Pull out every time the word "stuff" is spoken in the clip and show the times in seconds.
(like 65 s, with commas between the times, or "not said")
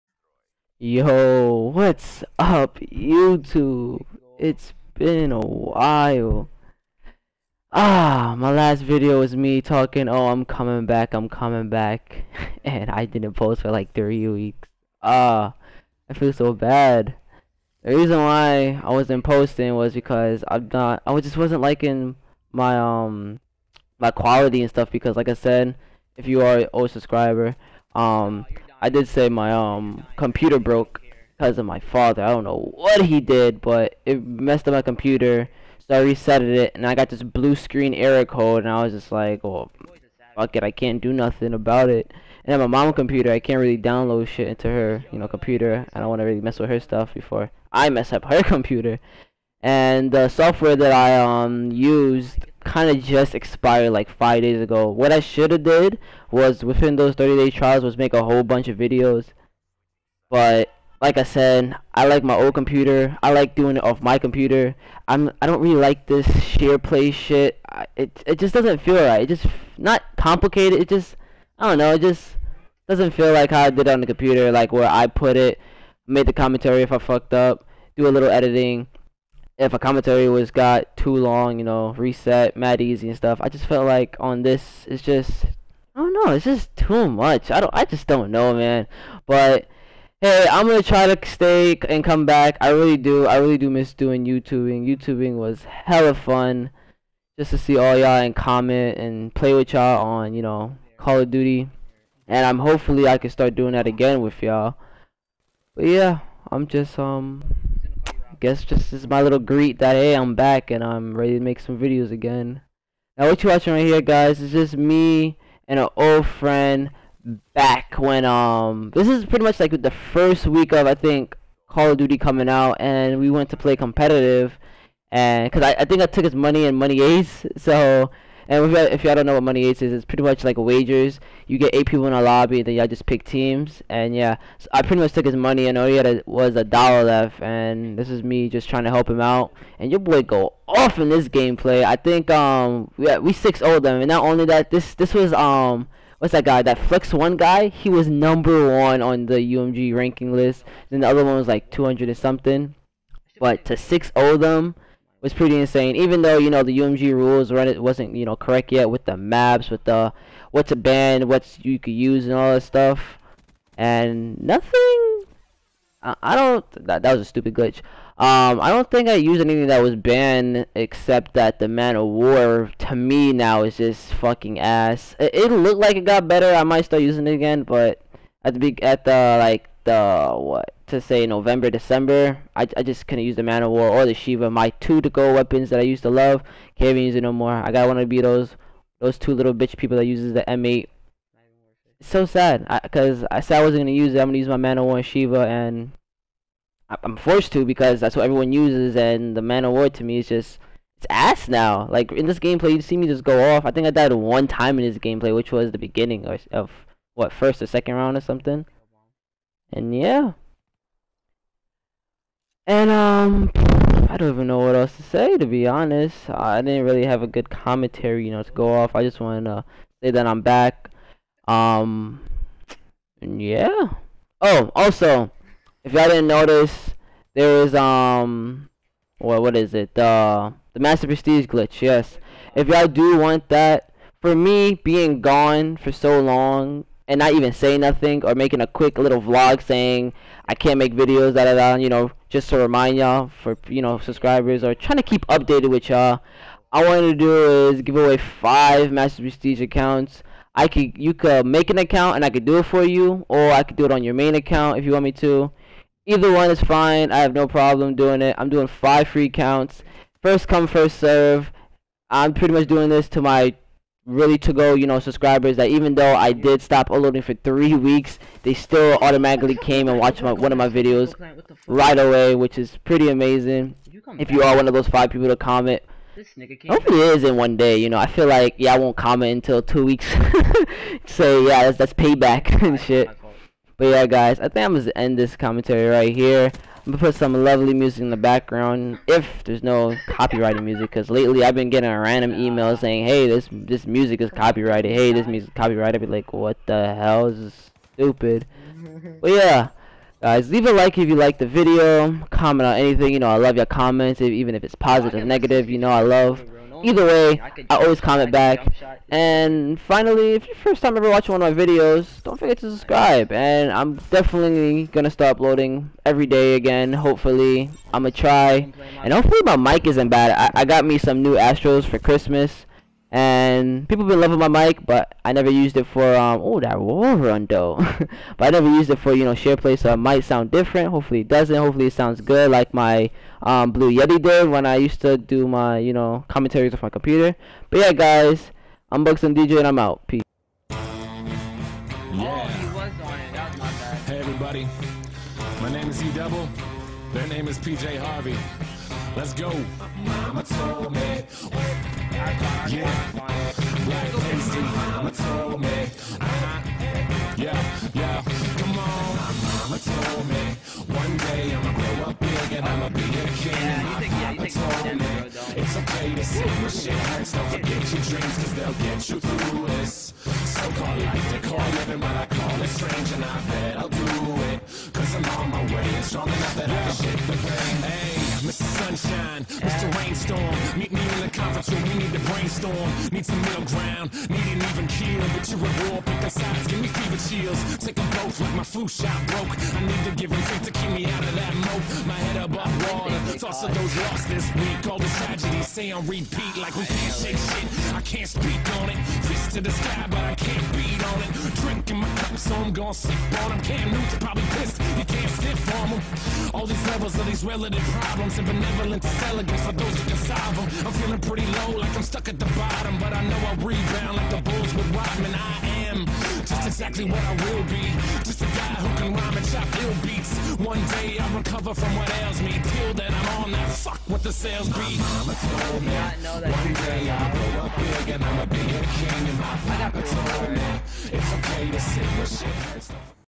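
24 s, 46 s, 83 s, 162 s.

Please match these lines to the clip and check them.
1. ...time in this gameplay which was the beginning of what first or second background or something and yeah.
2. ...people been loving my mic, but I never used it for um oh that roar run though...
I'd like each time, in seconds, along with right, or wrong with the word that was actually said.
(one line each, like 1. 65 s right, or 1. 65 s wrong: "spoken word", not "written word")
1. 204 s wrong: "round", not "background"
2. 323 s right.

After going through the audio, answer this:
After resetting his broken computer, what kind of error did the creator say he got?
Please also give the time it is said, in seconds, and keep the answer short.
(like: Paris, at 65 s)
blue screen error code, at 37 s.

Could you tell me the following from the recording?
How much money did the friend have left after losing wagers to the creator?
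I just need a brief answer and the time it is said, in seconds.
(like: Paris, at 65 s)
a dollar, at 136 s.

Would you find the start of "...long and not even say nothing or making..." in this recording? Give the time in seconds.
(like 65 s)
236 s.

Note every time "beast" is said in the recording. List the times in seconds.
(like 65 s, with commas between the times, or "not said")
not said.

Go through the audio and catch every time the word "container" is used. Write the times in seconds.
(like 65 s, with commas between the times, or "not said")
not said.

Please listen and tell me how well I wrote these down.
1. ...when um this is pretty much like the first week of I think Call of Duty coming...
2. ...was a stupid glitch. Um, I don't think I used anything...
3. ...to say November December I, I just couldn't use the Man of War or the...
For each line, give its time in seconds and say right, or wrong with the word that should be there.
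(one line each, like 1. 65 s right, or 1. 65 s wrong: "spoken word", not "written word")
1. 117 s right
2. 167 s right
3. 180 s right.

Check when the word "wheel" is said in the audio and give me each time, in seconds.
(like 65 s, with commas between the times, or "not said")
not said.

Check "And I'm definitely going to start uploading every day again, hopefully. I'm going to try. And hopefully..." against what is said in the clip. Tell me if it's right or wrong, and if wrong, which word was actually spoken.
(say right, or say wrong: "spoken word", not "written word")
right.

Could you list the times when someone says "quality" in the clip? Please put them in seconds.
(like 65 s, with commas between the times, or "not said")
24 s.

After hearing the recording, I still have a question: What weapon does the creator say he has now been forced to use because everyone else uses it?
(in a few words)
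M8.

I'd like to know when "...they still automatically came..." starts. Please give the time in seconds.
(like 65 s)
268 s.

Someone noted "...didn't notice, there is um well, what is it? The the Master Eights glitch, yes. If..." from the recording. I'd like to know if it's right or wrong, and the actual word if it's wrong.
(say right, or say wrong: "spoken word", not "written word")
wrong: "Prestige", not "Eights".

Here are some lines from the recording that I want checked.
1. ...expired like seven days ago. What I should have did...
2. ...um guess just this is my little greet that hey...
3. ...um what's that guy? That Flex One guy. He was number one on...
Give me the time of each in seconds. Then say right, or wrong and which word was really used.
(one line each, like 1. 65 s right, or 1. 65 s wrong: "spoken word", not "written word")
1. 53 s wrong: "five", not "seven"
2. 106 s right
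3. 145 s right.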